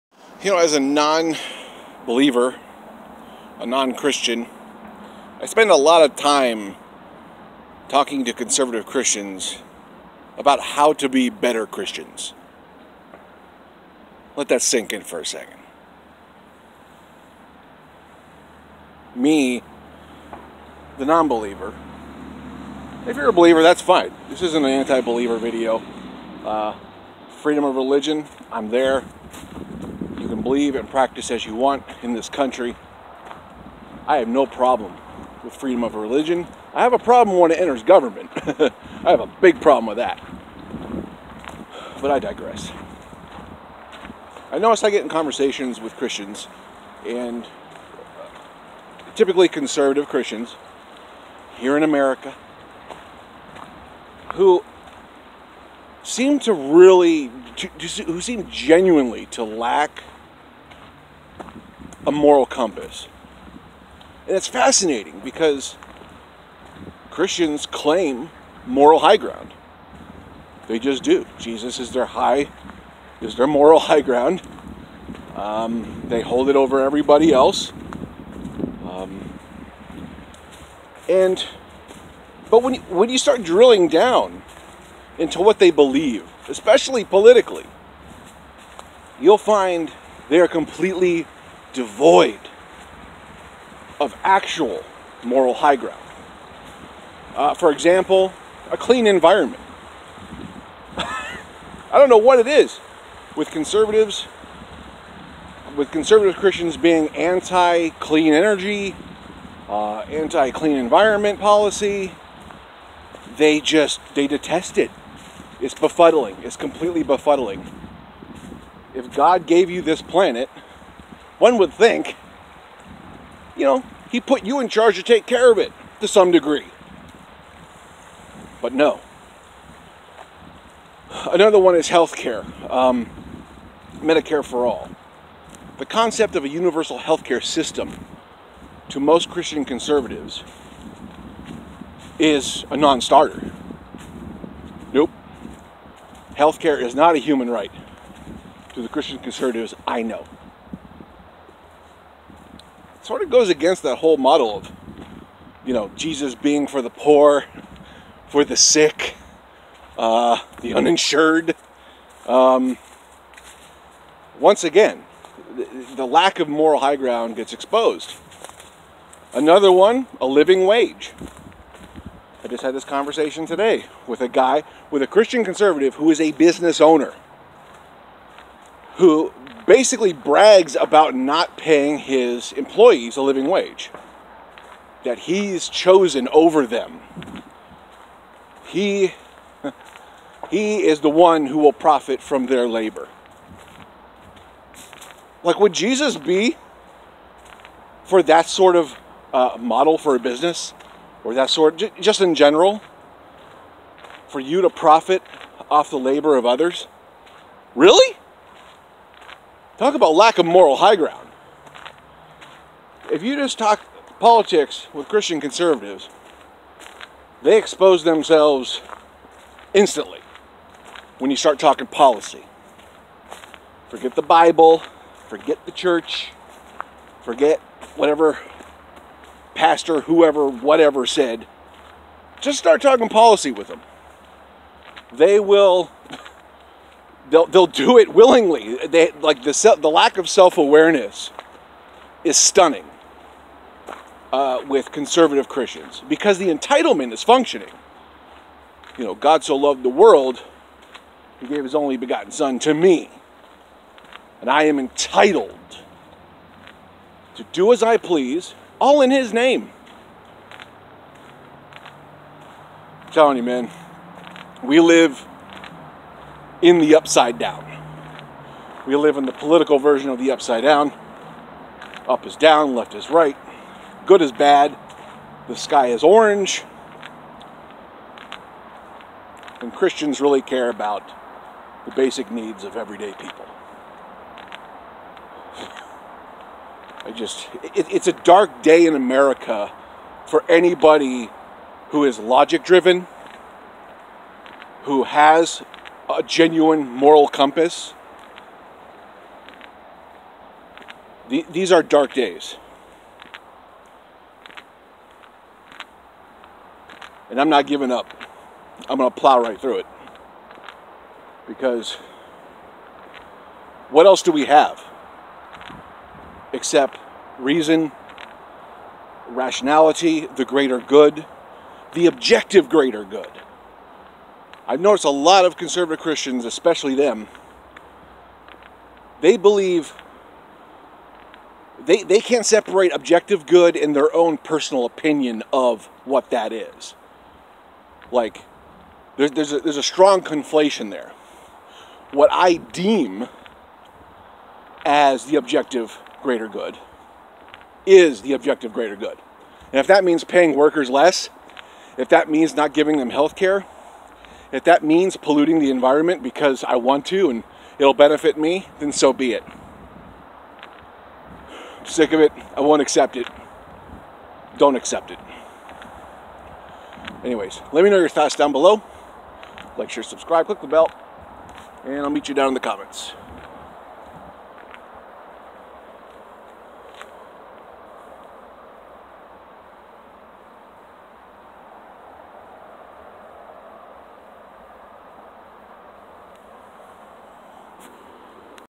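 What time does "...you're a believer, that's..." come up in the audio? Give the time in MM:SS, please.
00:23.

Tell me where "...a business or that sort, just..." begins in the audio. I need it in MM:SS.
03:20.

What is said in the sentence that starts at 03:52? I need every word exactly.
Just start talking policy with them.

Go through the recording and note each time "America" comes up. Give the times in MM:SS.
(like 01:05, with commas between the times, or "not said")
00:51, 04:48.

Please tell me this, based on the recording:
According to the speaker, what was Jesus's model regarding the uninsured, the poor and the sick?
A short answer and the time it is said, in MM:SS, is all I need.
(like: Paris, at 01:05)
For the poor, at 02:36.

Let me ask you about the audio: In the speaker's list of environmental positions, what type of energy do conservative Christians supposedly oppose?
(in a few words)
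Clean energy.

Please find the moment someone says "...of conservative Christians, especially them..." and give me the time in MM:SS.
05:25.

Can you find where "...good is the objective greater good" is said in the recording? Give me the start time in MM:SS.
05:46.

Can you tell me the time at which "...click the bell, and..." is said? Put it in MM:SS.
06:10.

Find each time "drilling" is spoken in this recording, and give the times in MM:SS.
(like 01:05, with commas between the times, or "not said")
01:23.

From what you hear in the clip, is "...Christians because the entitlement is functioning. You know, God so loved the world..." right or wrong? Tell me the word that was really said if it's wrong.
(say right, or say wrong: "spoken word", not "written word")
right.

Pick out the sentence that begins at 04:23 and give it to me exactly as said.
I'm telling you, man, we live in the upside down.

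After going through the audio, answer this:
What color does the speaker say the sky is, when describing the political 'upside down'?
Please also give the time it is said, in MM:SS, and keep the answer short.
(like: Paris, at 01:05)
Orange, at 04:36.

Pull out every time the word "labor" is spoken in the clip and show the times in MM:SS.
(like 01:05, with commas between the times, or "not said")
03:12, 03:25.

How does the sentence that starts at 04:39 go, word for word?
And Christians really care about the basic needs of everyday people.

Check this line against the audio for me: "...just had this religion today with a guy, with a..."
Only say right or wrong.
wrong.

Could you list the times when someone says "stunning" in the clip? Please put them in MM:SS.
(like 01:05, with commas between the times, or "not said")
04:02.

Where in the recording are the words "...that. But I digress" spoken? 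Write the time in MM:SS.
00:39.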